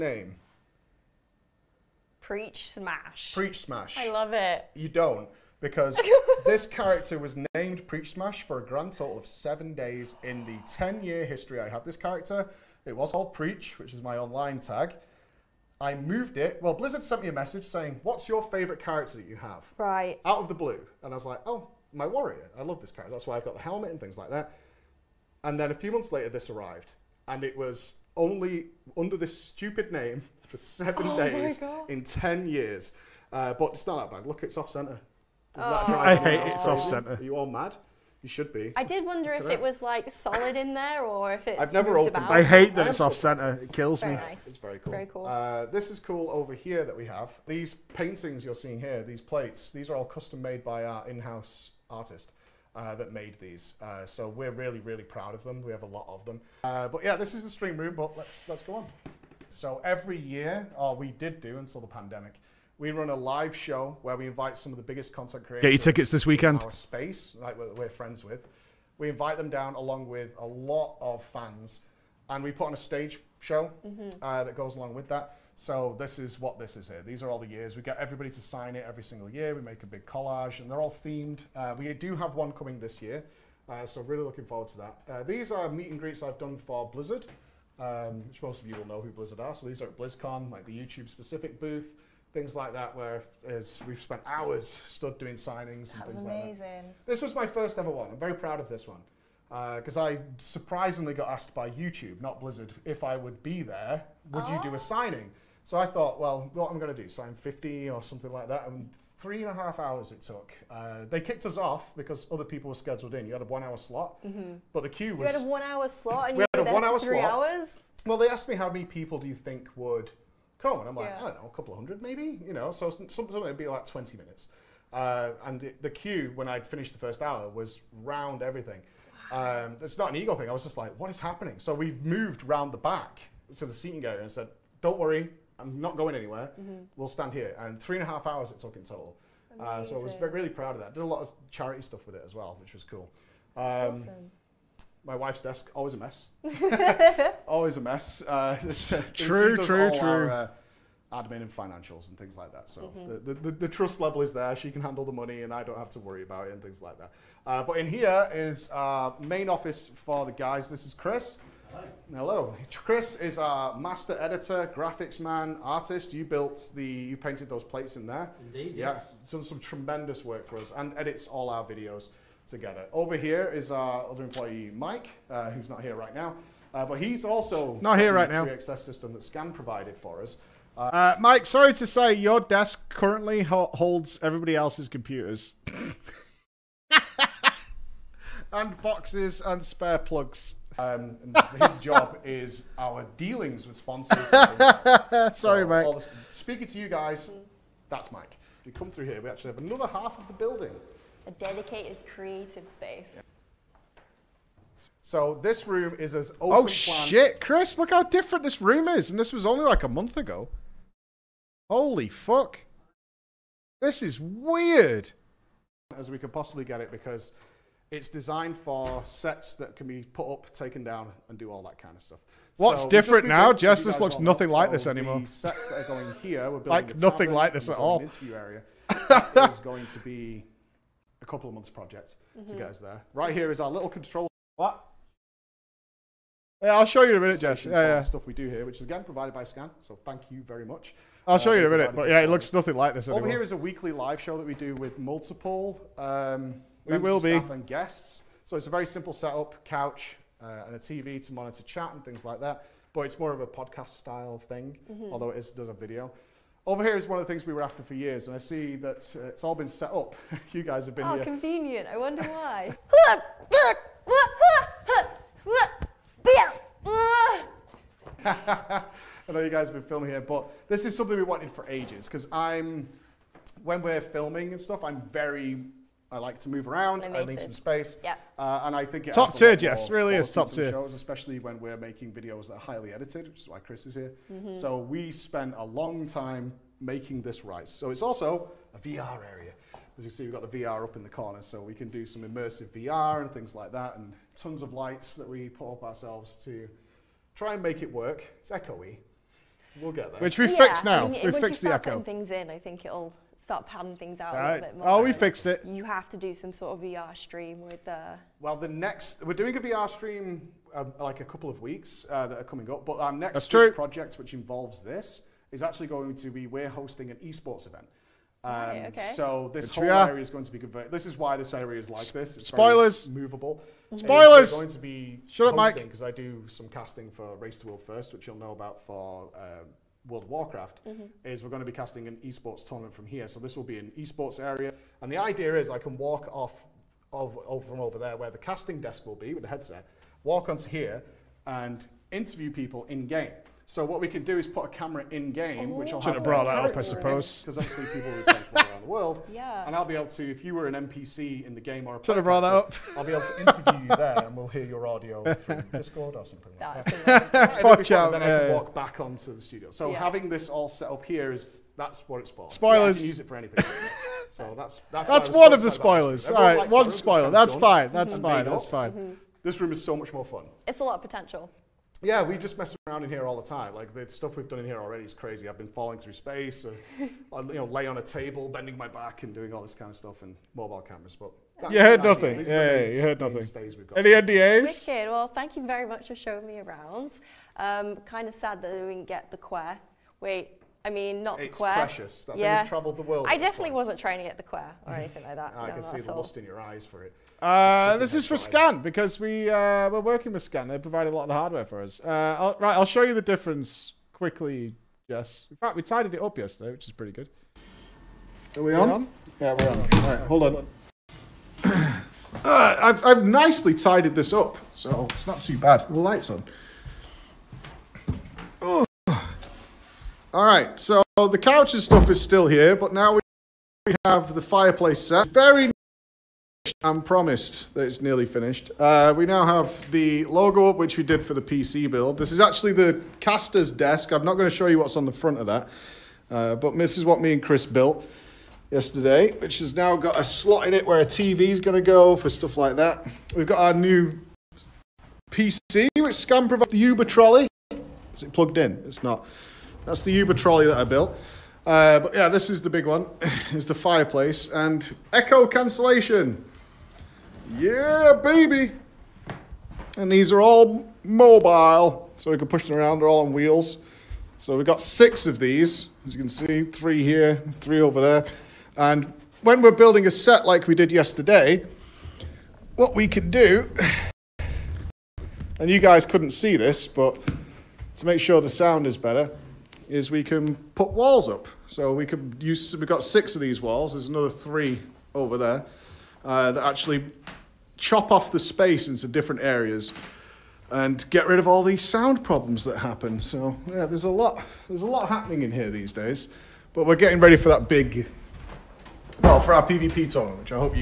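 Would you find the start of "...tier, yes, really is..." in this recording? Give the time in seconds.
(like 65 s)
279 s.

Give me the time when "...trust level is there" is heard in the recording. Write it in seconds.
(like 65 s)
153 s.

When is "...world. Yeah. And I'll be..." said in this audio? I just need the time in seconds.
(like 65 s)
348 s.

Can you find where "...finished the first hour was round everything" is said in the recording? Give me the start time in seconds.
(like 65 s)
126 s.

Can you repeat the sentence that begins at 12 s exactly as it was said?
It was called Preach, which is my online tag.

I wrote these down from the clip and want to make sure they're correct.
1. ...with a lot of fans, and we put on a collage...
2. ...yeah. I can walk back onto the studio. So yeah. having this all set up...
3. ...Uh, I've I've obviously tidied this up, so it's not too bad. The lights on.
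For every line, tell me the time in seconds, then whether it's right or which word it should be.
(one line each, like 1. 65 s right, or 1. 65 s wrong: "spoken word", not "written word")
1. 70 s wrong: "stage", not "collage"
2. 358 s right
3. 412 s wrong: "nicely", not "obviously".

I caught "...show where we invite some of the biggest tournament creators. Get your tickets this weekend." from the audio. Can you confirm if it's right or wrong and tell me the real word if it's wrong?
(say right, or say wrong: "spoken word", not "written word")
wrong: "content", not "tournament".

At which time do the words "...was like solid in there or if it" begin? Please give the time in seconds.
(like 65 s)
39 s.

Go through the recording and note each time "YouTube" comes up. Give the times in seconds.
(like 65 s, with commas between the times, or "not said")
90 s, 101 s.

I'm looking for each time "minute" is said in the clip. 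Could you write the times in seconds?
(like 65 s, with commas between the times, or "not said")
124 s, 237 s, 241 s.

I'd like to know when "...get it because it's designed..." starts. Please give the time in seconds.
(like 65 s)
216 s.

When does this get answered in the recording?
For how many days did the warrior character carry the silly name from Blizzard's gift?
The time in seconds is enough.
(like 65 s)
9 s.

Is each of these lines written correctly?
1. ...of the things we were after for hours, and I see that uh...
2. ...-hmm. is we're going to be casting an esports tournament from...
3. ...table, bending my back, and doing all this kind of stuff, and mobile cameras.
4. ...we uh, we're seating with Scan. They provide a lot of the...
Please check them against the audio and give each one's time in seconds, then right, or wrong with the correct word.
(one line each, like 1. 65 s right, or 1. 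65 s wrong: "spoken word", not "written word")
1. 257 s wrong: "years", not "hours"
2. 330 s right
3. 378 s right
4. 399 s wrong: "working", not "seating".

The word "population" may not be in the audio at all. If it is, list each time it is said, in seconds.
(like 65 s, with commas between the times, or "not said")
not said.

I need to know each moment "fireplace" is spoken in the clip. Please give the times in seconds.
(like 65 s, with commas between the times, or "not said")
424 s, 453 s.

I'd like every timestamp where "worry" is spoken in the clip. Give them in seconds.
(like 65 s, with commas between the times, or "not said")
134 s, 156 s.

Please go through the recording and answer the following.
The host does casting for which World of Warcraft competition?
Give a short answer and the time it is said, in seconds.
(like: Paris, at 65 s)
Race to World First, at 327 s.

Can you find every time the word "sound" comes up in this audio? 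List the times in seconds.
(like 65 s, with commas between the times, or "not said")
478 s, 491 s.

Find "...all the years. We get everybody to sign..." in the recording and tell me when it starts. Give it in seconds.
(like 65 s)
77 s.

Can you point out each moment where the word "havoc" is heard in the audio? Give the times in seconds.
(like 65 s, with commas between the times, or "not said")
not said.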